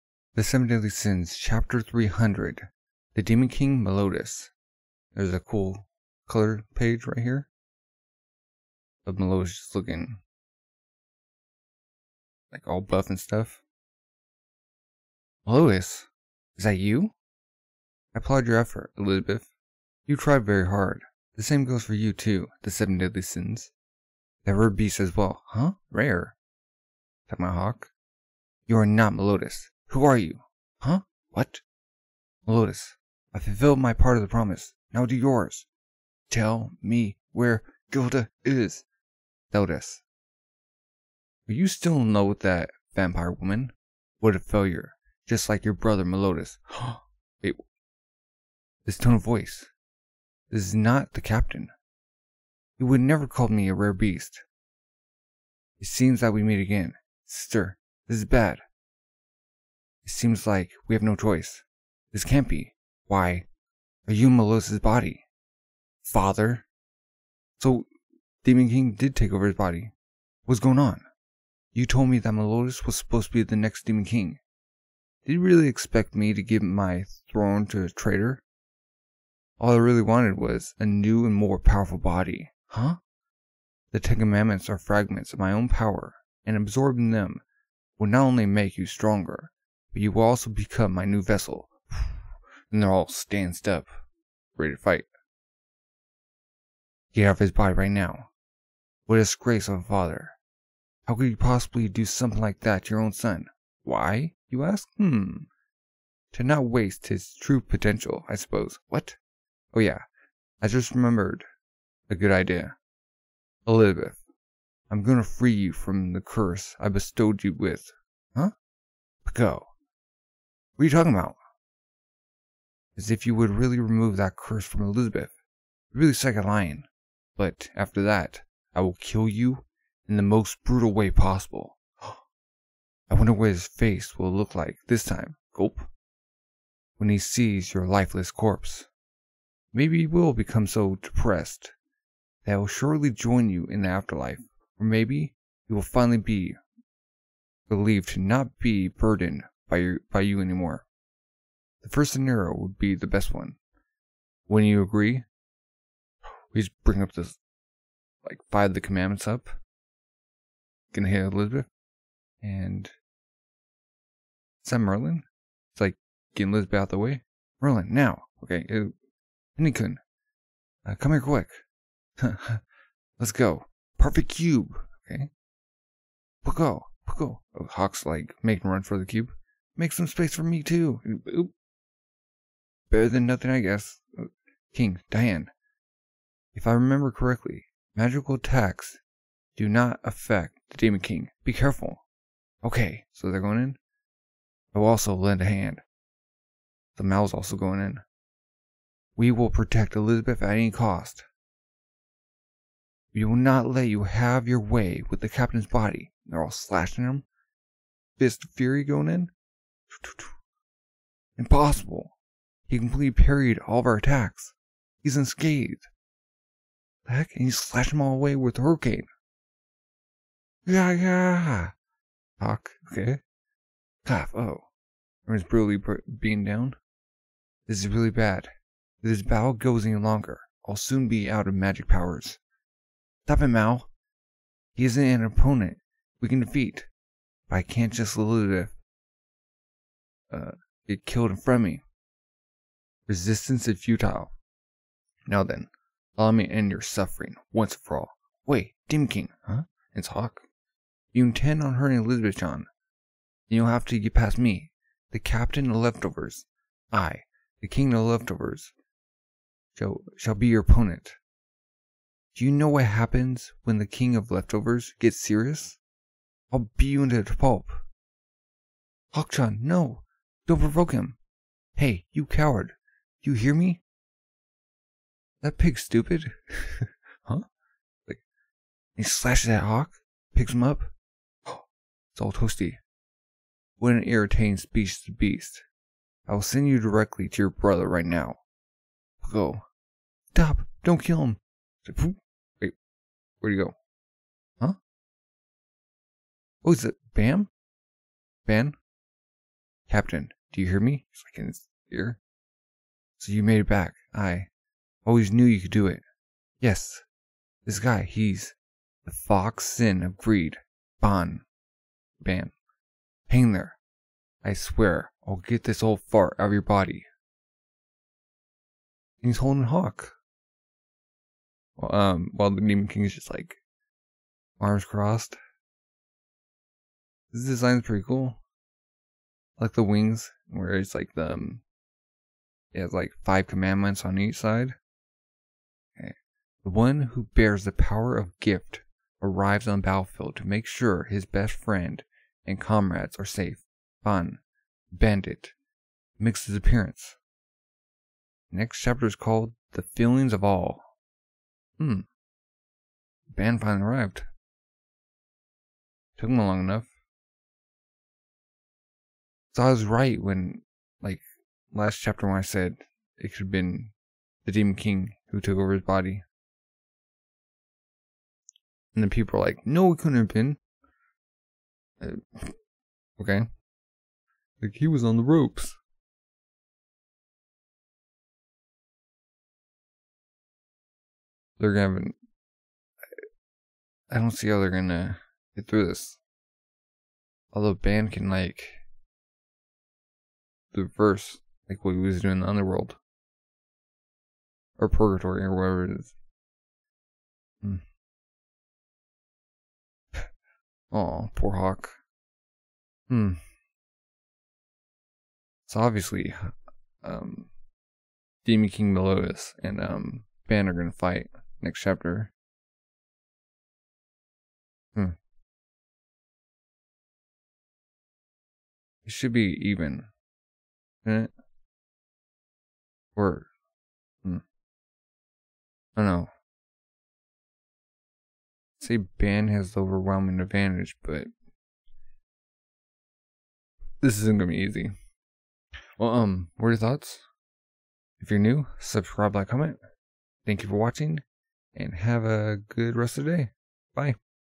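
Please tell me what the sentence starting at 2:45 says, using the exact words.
It's like getting Elizabeth out of the way.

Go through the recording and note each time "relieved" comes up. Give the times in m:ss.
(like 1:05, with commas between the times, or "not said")
2:27.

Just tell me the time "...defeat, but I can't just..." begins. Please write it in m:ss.
3:56.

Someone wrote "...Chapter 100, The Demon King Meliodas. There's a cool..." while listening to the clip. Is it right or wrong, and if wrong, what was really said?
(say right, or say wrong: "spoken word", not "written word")
wrong: "300", not "100".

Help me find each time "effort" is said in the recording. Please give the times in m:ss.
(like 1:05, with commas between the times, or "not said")
0:18.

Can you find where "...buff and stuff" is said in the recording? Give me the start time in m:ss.
0:12.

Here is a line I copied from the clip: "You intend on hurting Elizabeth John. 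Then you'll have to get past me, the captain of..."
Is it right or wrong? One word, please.
right.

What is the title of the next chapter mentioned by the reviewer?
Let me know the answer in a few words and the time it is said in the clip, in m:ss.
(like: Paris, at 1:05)
The Feelings of All, at 5:49.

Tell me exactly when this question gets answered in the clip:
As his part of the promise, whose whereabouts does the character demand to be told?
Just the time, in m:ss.
0:37.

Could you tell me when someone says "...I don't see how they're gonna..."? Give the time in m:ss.
6:24.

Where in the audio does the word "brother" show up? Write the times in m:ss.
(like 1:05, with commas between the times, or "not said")
0:45, 4:47.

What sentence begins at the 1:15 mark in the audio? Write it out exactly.
Did you really expect me to give my throne to a traitor?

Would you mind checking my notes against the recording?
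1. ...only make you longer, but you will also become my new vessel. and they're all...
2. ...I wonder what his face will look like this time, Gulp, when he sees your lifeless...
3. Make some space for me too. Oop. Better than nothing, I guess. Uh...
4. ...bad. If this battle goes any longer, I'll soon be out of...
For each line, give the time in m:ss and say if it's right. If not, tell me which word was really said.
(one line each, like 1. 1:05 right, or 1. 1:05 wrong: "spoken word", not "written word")
1. 1:28 wrong: "stronger", not "longer"
2. 2:12 right
3. 2:59 right
4. 3:48 right.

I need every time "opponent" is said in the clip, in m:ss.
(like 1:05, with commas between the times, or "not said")
3:55, 4:20.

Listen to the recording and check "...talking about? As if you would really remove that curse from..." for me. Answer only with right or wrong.
right.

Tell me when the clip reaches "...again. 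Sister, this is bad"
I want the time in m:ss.
0:56.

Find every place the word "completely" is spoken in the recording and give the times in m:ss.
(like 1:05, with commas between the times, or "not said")
3:32.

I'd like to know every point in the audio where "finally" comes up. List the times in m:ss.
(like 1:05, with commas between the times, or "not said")
2:25, 5:53.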